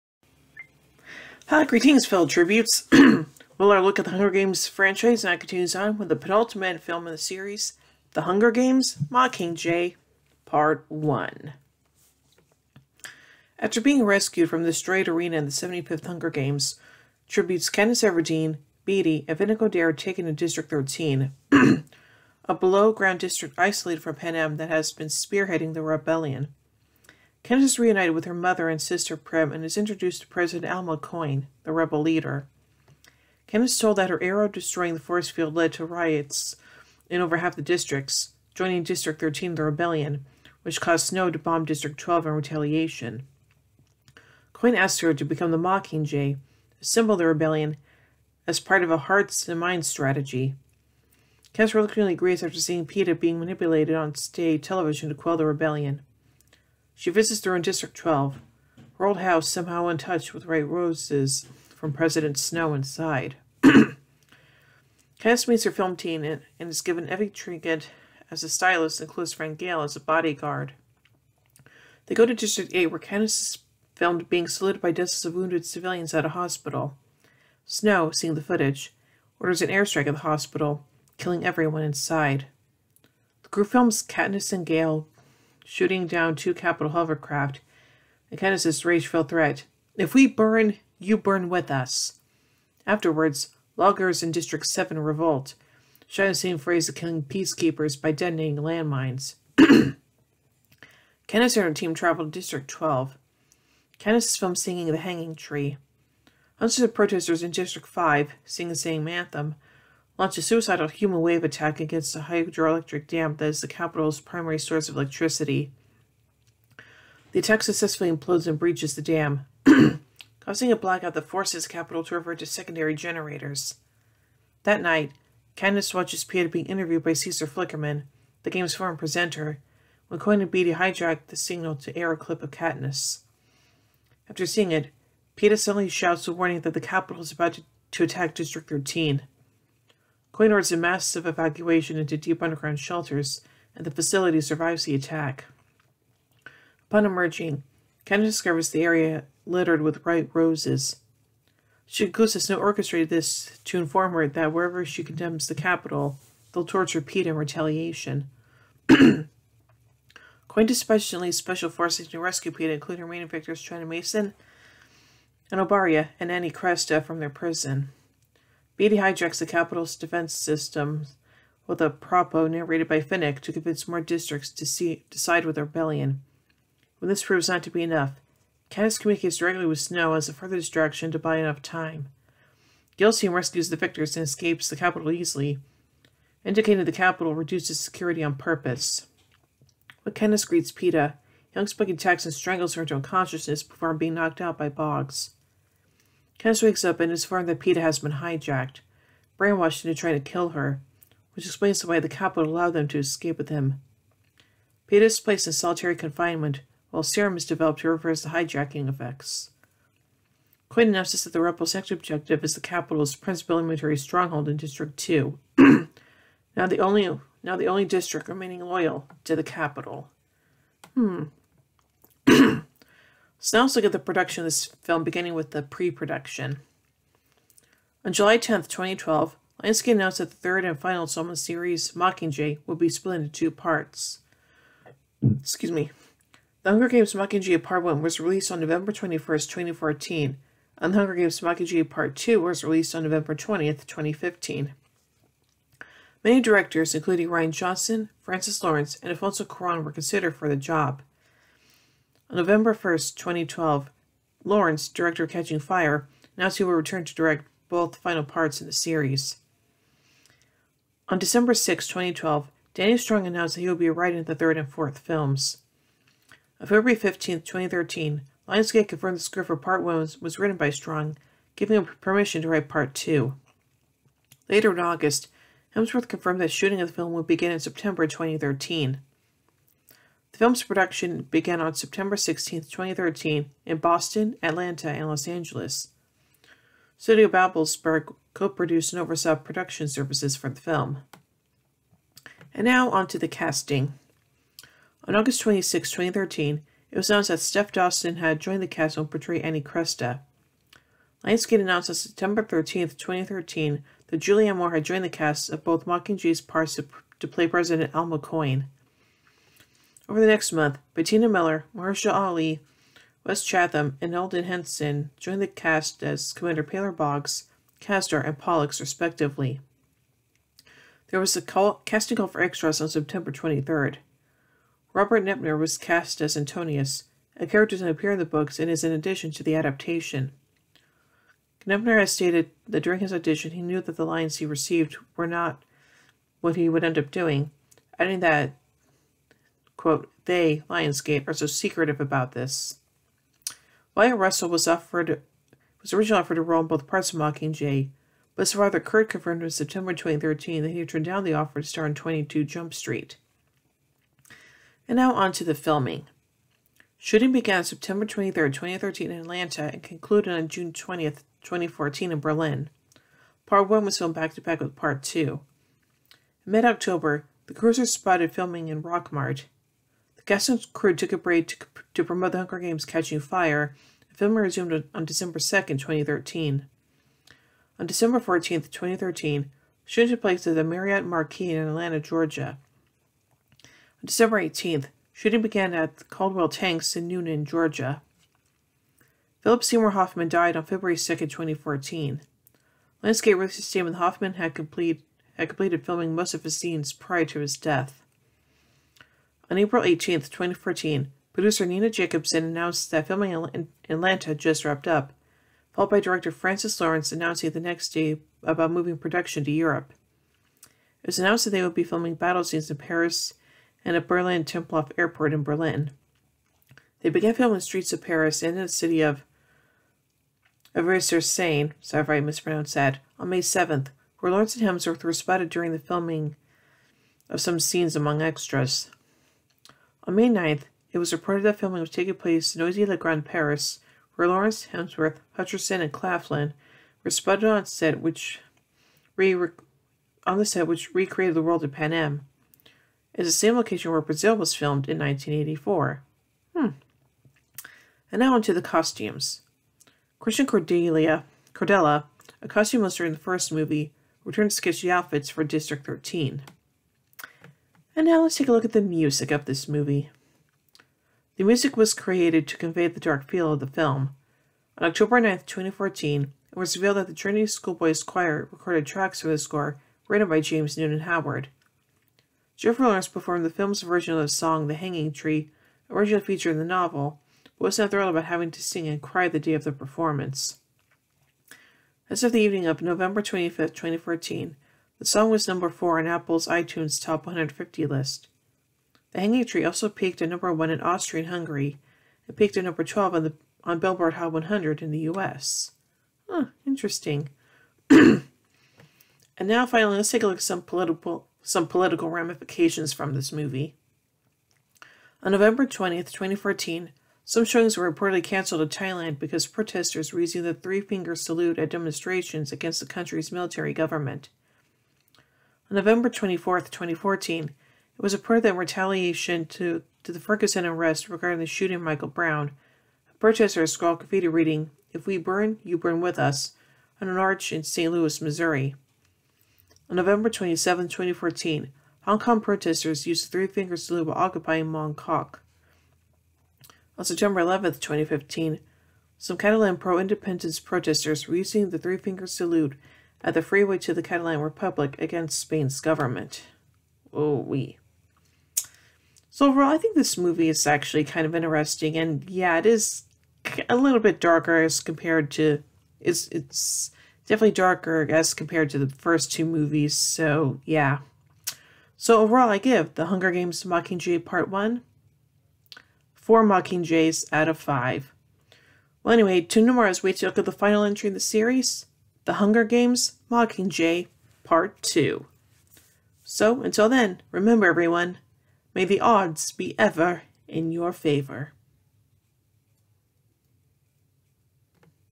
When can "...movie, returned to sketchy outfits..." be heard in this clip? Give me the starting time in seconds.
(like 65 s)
453 s.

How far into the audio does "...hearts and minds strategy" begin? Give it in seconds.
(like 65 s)
48 s.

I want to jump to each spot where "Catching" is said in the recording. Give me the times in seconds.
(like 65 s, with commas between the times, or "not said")
255 s, 372 s.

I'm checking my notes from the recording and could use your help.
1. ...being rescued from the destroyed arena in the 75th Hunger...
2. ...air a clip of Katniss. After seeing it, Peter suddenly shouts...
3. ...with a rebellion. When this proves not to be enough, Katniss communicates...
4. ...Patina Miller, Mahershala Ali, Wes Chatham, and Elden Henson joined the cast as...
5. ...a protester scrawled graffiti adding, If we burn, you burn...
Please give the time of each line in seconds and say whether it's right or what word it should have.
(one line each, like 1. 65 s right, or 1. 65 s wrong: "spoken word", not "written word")
1. 13 s right
2. 131 s right
3. 175 s right
4. 310 s right
5. 523 s wrong: "reading", not "adding".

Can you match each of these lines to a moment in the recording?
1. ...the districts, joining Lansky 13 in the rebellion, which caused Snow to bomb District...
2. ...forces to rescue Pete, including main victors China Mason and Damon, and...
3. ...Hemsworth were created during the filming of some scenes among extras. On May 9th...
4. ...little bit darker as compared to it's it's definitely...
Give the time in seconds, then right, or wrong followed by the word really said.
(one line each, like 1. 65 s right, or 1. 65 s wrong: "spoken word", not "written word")
1. 37 s wrong: "District", not "Lansky"
2. 161 s wrong: "Obaria", not "Damon"
3. 424 s wrong: "spotted", not "created"
4. 553 s right.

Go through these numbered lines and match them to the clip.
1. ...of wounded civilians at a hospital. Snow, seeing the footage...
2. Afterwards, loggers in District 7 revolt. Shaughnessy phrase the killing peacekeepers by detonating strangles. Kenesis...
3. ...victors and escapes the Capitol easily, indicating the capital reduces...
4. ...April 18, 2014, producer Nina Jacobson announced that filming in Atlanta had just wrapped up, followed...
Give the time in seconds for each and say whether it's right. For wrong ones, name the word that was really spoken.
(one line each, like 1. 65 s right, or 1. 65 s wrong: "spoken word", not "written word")
1. 75 s right
2. 92 s wrong: "landmines", not "strangles"
3. 183 s right
4. 399 s right.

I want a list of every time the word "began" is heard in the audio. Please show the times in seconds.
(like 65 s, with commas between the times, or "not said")
281 s, 357 s, 385 s, 417 s.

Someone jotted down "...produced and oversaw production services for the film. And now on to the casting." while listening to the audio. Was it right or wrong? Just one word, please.
right.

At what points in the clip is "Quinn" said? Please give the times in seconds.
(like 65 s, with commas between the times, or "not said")
210 s.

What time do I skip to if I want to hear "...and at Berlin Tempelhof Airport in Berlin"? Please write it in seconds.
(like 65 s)
413 s.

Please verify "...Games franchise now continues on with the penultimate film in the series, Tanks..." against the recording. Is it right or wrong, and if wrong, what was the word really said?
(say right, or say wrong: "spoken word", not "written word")
wrong: "The", not "Tanks".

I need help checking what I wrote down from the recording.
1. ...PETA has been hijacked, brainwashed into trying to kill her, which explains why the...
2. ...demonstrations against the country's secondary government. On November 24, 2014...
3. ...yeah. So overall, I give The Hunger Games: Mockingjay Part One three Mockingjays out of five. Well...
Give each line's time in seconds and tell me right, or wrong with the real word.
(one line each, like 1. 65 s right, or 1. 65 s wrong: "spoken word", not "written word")
1. 197 s right
2. 511 s wrong: "military", not "secondary"
3. 560 s wrong: "four", not "three".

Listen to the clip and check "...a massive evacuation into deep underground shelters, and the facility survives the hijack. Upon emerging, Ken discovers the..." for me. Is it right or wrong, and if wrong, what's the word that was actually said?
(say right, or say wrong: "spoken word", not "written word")
wrong: "attack", not "hijack".